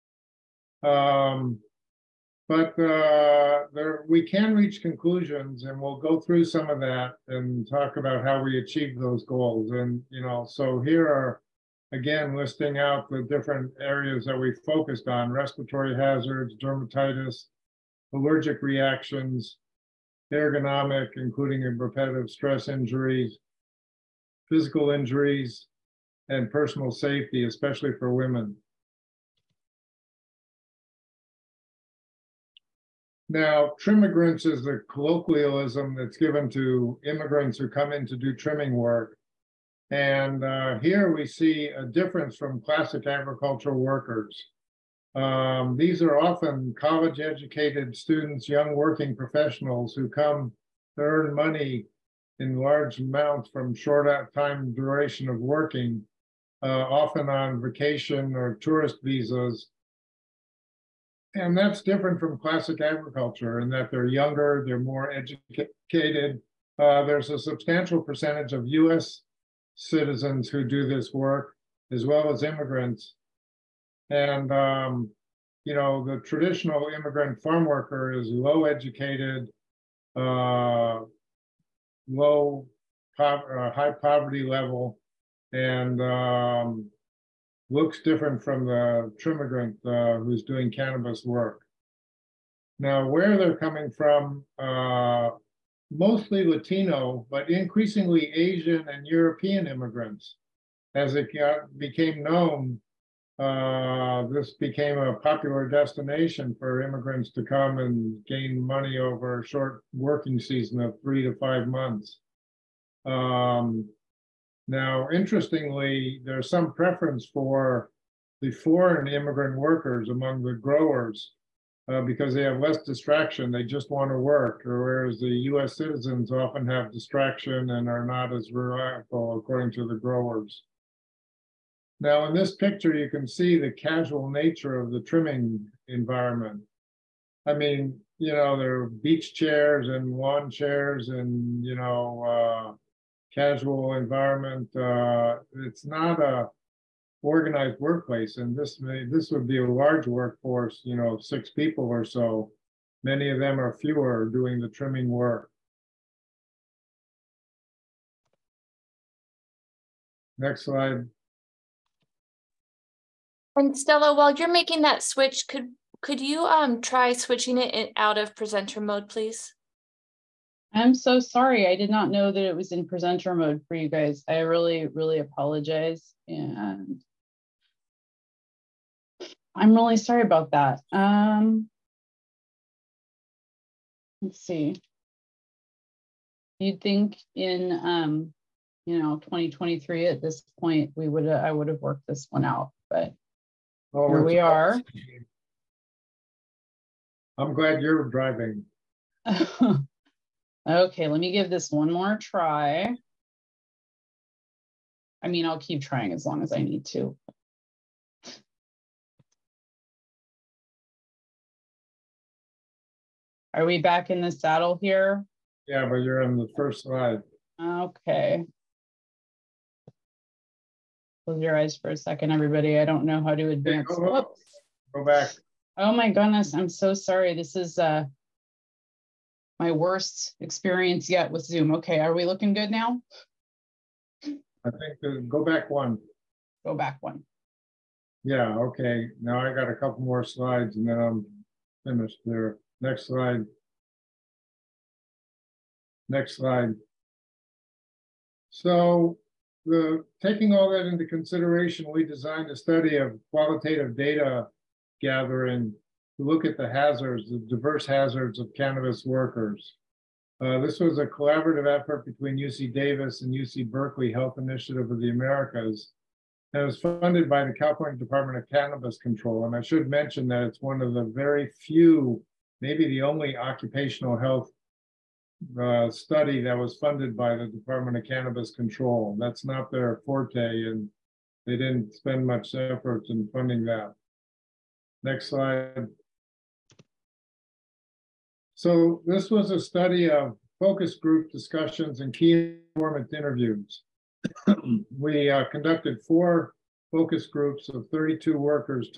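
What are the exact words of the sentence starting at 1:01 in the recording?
And that's different from classic agriculture in that they're younger, they're more educated.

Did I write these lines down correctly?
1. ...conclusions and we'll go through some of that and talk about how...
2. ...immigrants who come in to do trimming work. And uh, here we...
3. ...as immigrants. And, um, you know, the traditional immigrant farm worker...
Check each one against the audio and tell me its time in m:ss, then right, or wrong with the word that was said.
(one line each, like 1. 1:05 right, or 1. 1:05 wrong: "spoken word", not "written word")
1. 0:04 right
2. 0:37 right
3. 1:12 right.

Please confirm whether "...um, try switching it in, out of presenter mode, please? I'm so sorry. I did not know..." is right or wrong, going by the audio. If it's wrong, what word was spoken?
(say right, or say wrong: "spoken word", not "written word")
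right.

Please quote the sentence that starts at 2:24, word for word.
Uh, it's not a organized workplace.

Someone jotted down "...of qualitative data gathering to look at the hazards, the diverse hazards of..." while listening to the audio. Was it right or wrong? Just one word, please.
right.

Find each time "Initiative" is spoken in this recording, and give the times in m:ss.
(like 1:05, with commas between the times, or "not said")
4:24.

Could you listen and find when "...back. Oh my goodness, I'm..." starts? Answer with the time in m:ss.
3:45.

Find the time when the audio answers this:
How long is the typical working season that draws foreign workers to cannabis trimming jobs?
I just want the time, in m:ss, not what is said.
1:51.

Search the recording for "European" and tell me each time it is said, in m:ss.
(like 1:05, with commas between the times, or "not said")
1:39.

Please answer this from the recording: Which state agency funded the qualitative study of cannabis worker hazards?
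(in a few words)
California Department of Cannabis Control.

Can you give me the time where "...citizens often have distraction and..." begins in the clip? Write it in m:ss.
2:05.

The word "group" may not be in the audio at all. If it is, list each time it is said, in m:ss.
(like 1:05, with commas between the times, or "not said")
4:50, 4:57.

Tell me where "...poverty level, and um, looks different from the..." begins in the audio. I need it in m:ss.
1:23.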